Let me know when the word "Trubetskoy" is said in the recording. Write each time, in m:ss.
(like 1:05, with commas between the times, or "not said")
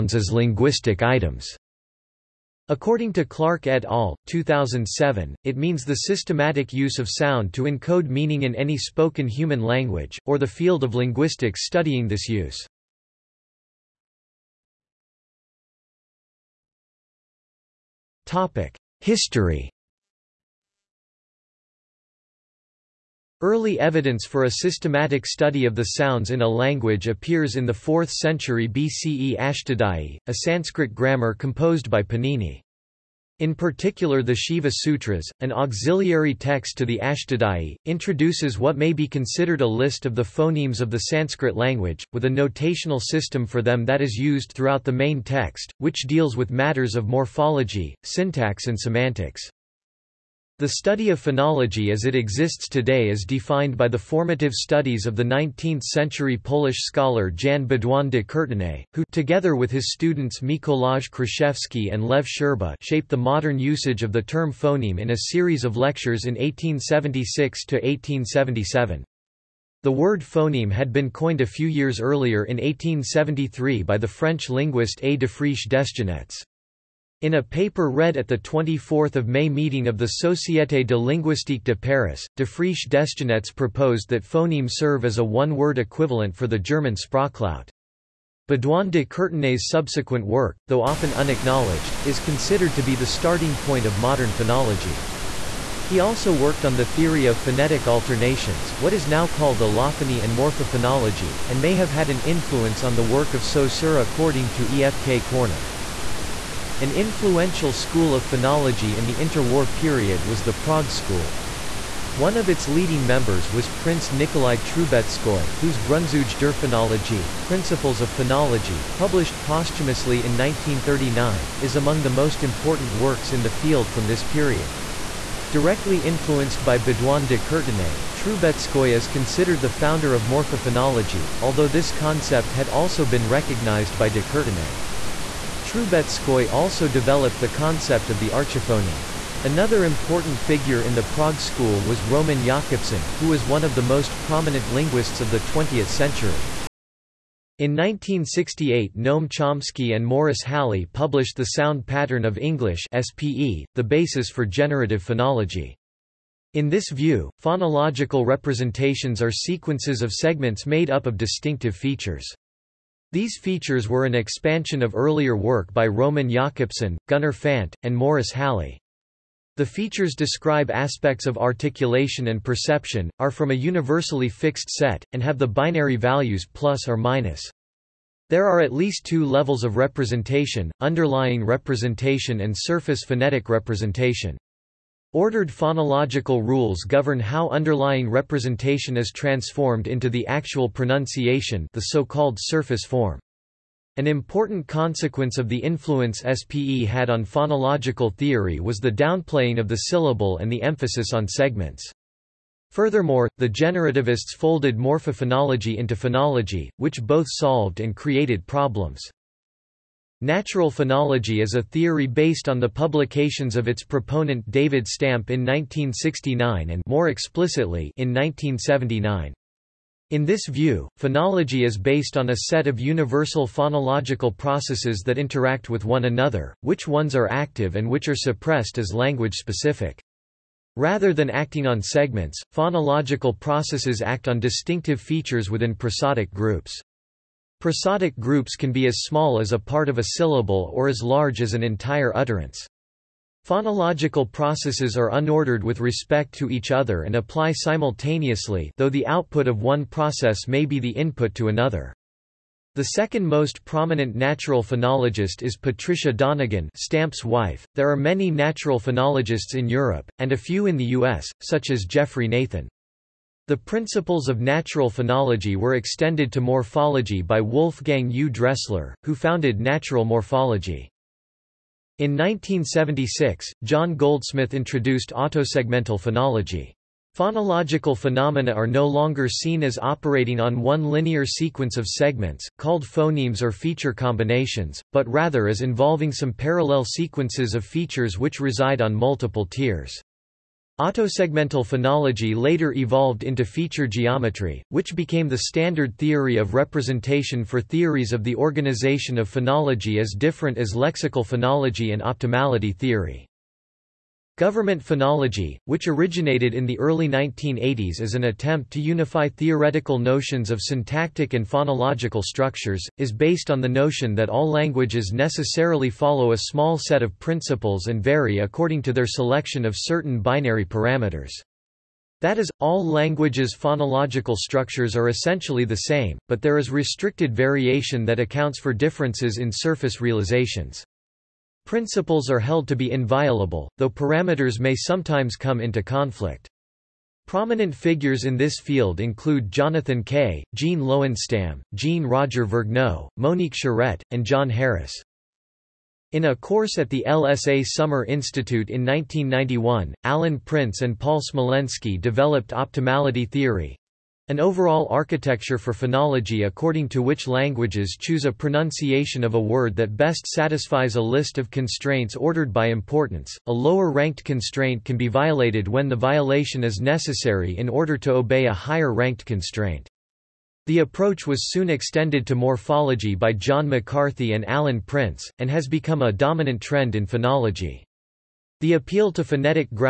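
1:54, 2:08, 2:15.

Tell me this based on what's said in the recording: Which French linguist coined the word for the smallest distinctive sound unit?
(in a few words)
A. de Friche Desgenettes.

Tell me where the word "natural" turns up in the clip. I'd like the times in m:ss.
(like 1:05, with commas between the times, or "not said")
3:30, 4:14, 4:18, 4:24, 4:29.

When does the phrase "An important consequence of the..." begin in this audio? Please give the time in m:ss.
3:13.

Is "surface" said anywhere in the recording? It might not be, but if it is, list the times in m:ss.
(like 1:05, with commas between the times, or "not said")
3:02, 3:12, 5:29.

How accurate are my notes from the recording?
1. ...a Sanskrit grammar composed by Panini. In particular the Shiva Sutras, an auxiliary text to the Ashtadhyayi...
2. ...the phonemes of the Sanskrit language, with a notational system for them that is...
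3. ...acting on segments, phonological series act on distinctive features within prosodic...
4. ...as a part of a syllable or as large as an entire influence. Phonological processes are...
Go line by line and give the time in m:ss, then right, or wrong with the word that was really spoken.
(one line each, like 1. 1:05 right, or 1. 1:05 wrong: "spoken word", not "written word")
1. 0:30 right
2. 0:40 right
3. 3:51 wrong: "processes", not "series"
4. 3:59 wrong: "utterance", not "influence".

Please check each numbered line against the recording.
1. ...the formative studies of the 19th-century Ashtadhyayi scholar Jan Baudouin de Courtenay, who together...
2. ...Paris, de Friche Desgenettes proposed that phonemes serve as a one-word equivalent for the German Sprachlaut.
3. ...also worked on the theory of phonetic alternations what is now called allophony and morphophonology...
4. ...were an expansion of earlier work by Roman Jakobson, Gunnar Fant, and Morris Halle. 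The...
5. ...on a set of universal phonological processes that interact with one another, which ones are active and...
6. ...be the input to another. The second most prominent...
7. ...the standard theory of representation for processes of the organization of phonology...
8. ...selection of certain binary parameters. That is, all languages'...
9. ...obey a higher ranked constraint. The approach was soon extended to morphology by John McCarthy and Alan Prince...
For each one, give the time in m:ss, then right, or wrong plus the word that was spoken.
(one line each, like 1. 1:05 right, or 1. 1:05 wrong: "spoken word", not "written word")
1. 0:53 wrong: "Polish", not "Ashtadhyayi"
2. 1:21 right
3. 1:35 right
4. 2:43 right
5. 3:42 right
6. 4:10 right
7. 4:55 wrong: "theories", not "processes"
8. 5:19 right
9. 6:08 right.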